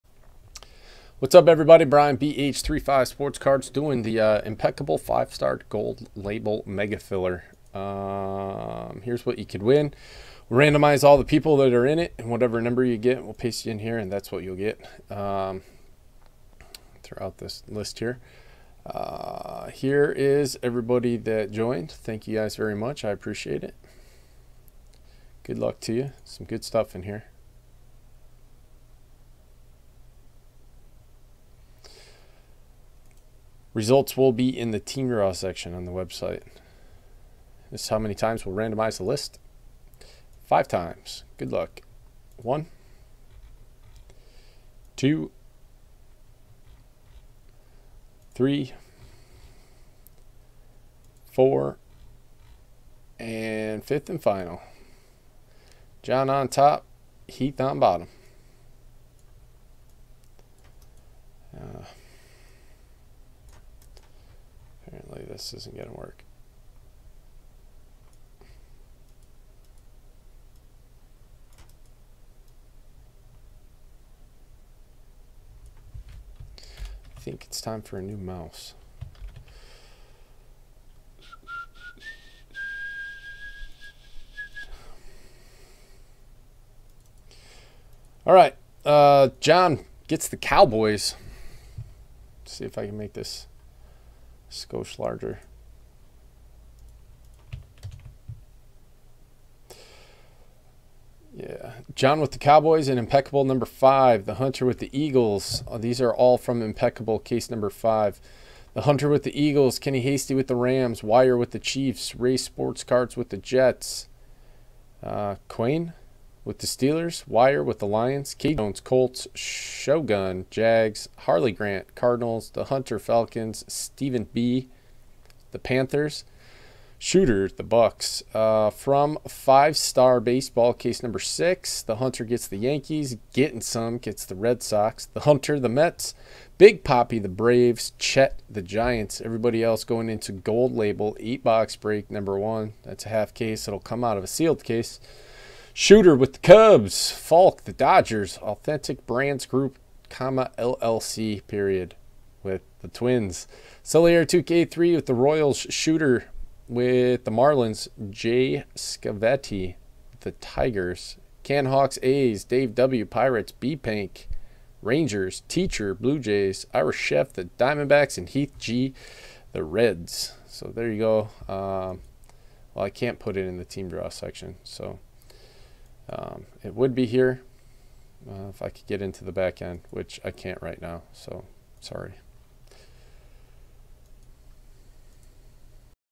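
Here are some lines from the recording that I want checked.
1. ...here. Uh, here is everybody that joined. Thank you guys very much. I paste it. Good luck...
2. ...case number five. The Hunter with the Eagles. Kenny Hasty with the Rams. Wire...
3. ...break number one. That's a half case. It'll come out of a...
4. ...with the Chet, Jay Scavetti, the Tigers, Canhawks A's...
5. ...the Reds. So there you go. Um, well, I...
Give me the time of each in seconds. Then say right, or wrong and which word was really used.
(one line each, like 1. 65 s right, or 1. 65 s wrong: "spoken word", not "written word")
1. 17 s wrong: "appreciate", not "paste"
2. 107 s right
3. 141 s right
4. 156 s wrong: "Marlins", not "Chet"
5. 169 s right.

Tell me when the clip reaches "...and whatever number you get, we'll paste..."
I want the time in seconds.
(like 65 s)
12 s.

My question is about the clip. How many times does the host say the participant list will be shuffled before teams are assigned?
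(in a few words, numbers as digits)
5.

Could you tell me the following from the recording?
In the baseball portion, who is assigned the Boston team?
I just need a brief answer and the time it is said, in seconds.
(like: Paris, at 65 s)
Getting Some, at 133 s.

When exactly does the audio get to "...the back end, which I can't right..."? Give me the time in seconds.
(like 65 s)
179 s.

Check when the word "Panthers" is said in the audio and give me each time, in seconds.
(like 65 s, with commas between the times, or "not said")
125 s.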